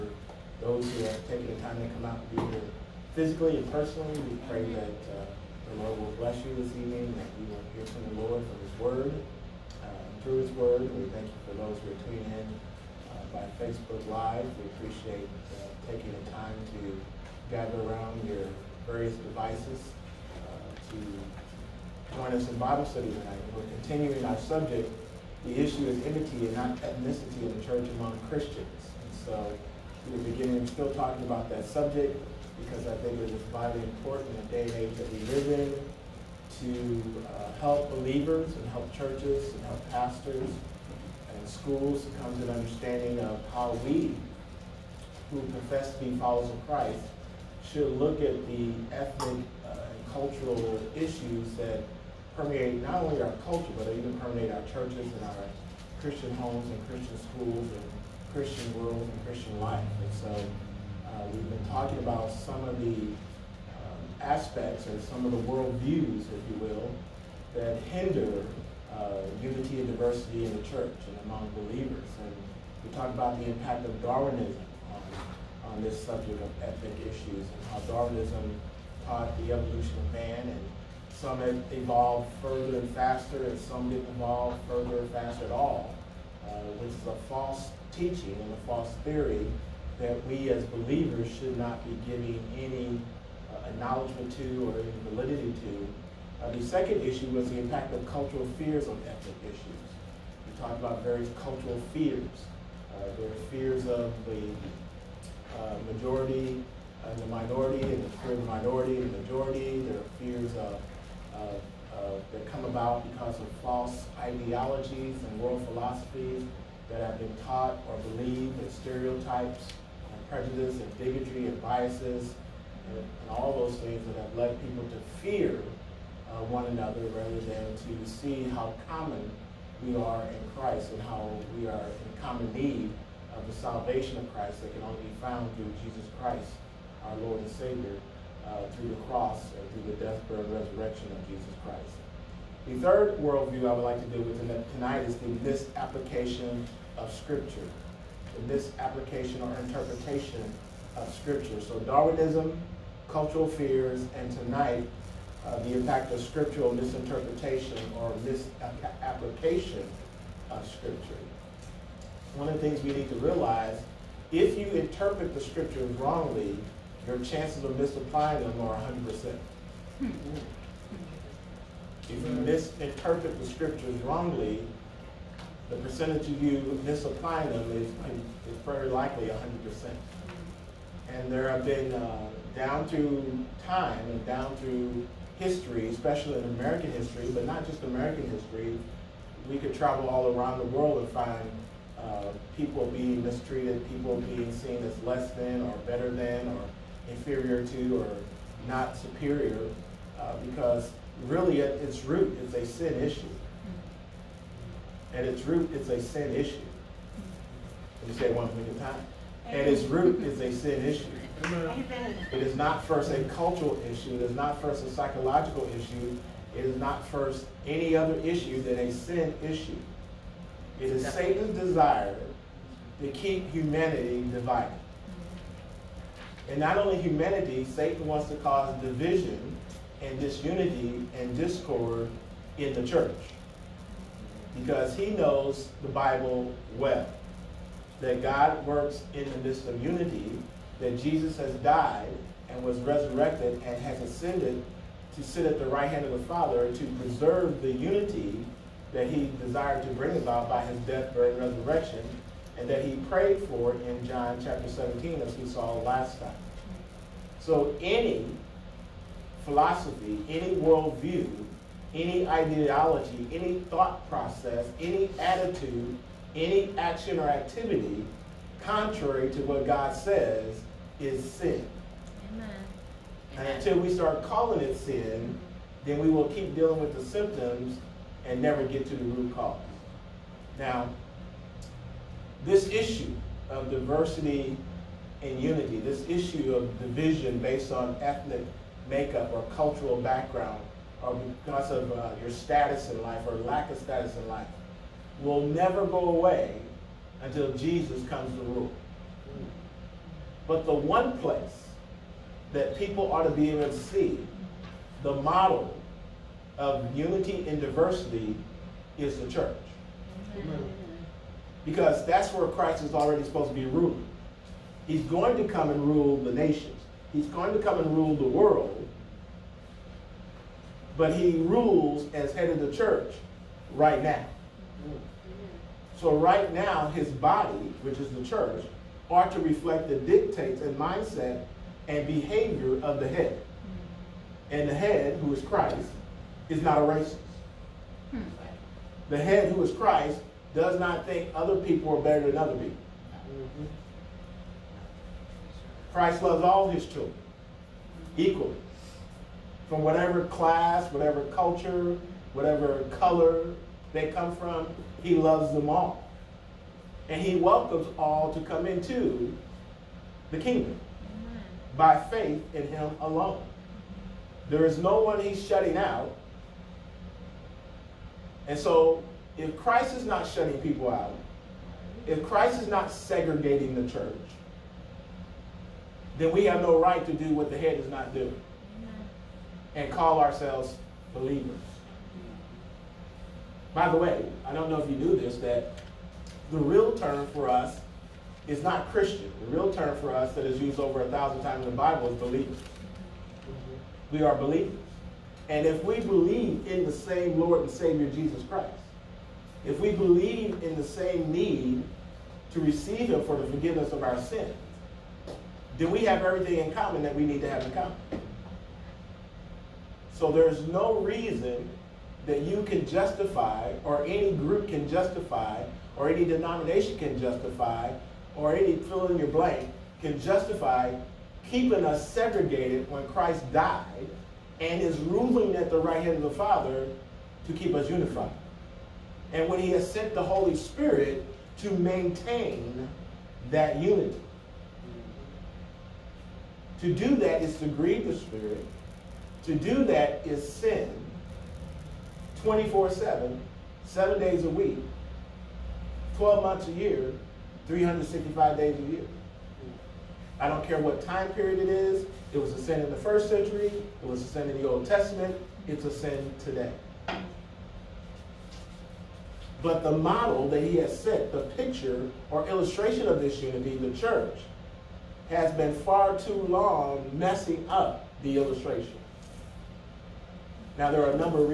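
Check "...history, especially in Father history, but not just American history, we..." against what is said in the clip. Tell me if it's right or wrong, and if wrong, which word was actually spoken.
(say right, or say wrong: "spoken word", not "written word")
wrong: "American", not "Father".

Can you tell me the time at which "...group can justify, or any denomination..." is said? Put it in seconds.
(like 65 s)
414 s.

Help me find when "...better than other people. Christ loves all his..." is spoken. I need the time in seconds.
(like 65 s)
342 s.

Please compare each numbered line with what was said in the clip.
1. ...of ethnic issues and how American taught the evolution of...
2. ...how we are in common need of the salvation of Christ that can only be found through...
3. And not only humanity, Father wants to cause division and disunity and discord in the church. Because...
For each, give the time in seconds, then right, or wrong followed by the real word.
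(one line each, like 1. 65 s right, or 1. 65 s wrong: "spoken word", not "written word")
1. 76 s wrong: "Darwinism", not "American"
2. 131 s right
3. 226 s wrong: "Satan", not "Father".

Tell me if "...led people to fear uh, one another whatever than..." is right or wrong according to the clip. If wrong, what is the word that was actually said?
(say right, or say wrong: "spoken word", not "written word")
wrong: "rather", not "whatever".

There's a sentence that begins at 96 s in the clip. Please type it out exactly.
Uh, the second issue was the impact of cultural fears on ethnic issues.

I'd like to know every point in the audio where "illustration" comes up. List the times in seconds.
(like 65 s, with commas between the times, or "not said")
462 s, 468 s.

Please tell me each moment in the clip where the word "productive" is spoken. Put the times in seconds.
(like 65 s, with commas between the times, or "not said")
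not said.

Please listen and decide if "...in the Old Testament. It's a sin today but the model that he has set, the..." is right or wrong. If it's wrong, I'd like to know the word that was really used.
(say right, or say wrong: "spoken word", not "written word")
right.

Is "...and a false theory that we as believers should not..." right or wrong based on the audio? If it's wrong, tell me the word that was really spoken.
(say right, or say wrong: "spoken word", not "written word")
right.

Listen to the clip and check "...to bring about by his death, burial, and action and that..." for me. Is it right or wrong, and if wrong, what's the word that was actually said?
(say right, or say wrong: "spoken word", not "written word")
wrong: "resurrection", not "action".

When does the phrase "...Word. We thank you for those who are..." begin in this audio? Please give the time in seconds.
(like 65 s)
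10 s.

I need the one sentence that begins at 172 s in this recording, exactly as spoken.
If you misinterpret the scriptures wrongly, the percentage of you misapplying them is, is very likely 100%.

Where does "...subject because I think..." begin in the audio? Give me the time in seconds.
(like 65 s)
31 s.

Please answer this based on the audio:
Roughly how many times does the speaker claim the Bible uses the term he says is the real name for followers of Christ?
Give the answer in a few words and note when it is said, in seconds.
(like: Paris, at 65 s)
Over 1,000, at 390 s.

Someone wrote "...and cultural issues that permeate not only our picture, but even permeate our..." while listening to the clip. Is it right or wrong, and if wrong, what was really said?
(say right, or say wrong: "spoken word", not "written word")
wrong: "culture", not "picture".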